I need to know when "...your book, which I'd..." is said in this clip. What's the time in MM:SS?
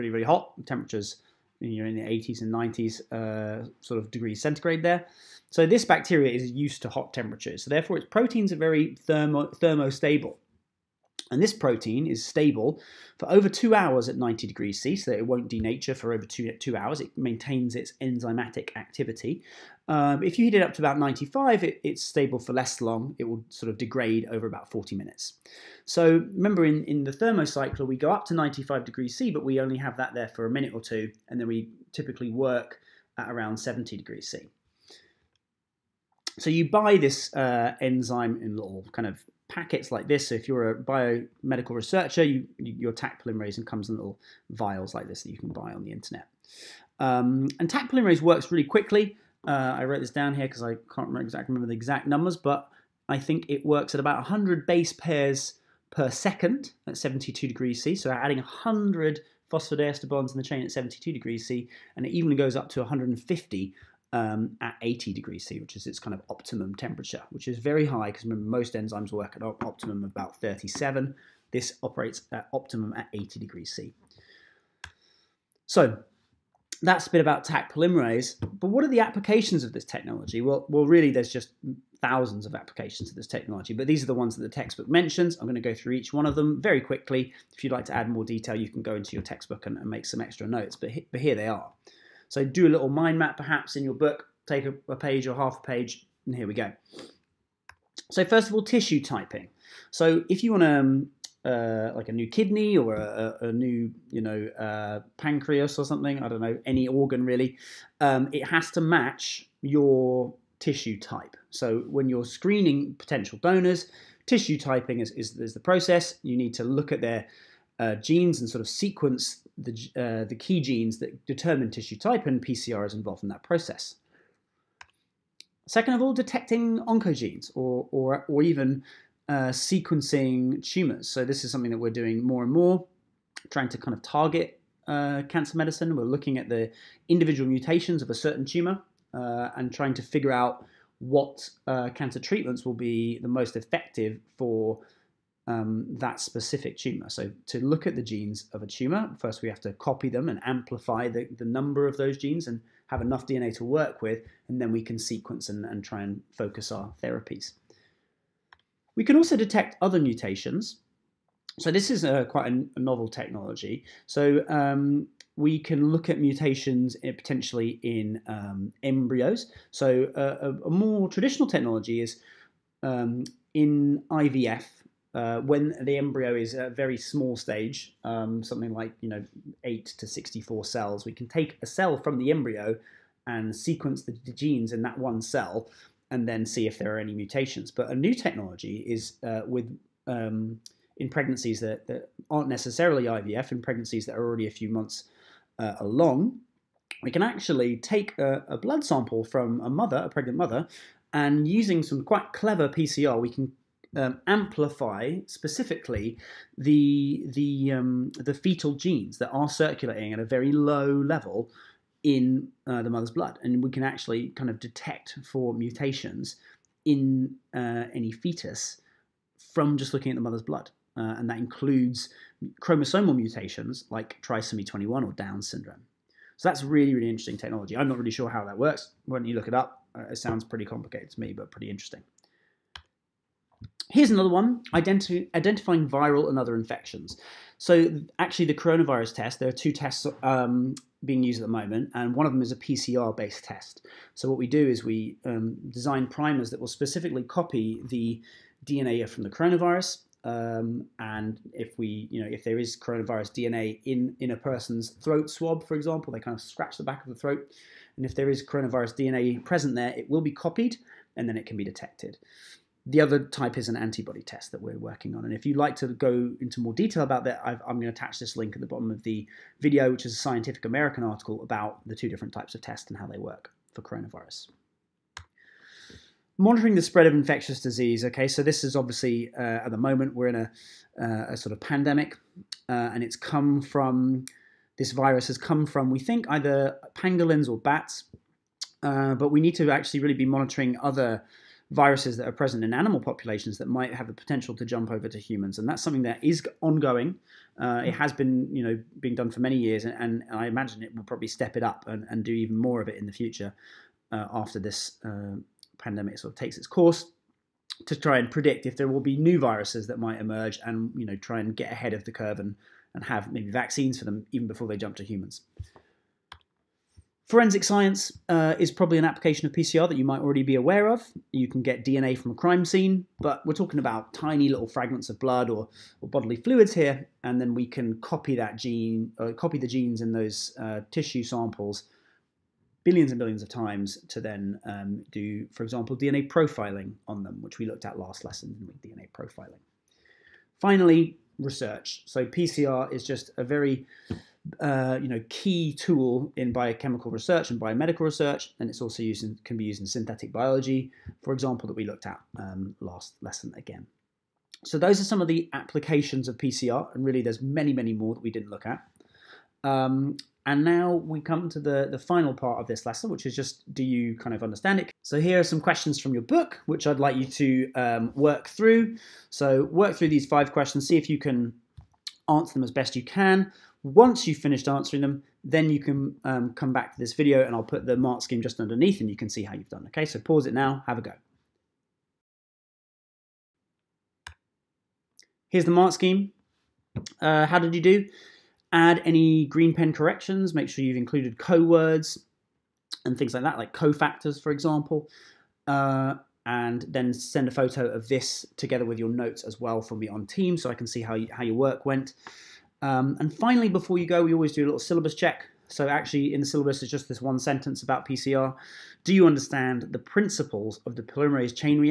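06:06.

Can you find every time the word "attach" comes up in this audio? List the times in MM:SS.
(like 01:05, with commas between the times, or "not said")
04:27.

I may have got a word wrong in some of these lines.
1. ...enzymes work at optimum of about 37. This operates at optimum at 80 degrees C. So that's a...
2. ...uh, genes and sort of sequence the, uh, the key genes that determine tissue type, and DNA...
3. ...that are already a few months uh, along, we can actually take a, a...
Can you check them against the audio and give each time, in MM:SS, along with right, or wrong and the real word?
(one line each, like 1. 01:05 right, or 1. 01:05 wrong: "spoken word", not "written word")
1. 01:08 right
2. 01:57 wrong: "PCR", not "DNA"
3. 03:14 right.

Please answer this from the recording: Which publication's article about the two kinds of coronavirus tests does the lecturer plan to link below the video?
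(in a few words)
Scientific American.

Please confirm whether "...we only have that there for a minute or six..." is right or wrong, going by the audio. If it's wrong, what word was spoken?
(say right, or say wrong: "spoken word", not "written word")
wrong: "two", not "six".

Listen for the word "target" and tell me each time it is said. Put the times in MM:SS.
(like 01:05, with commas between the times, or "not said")
02:14.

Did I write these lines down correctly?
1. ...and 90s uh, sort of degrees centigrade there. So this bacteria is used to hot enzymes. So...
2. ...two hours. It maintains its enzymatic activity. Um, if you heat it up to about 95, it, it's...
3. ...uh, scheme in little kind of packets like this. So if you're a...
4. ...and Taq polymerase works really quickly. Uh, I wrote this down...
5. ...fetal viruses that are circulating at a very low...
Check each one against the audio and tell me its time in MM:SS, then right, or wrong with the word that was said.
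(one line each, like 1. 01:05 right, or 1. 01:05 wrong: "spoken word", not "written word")
1. 00:02 wrong: "temperatures", not "enzymes"
2. 00:16 right
3. 00:37 wrong: "enzyme", not "scheme"
4. 00:47 right
5. 03:28 wrong: "genes", not "viruses".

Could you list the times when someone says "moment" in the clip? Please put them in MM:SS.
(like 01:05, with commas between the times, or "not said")
04:01, 04:39.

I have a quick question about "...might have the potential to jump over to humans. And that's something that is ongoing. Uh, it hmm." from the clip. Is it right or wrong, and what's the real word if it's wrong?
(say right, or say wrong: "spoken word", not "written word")
right.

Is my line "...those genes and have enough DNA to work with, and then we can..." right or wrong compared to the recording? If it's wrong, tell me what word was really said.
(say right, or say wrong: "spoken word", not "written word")
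right.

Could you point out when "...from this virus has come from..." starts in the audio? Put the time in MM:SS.
04:43.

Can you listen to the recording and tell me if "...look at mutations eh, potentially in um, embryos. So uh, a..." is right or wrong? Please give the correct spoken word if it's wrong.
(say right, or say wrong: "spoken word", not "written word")
right.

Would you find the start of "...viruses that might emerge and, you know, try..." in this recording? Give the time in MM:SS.
05:09.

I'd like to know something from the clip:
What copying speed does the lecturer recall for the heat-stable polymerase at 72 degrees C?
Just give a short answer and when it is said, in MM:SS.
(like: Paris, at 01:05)
100 base pairs per second, at 00:54.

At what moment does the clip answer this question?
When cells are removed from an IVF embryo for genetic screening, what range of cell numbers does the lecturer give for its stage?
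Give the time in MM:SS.
02:59.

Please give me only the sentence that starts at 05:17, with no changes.
Forensic science uh, is probably an application of PCR that you might already be aware of.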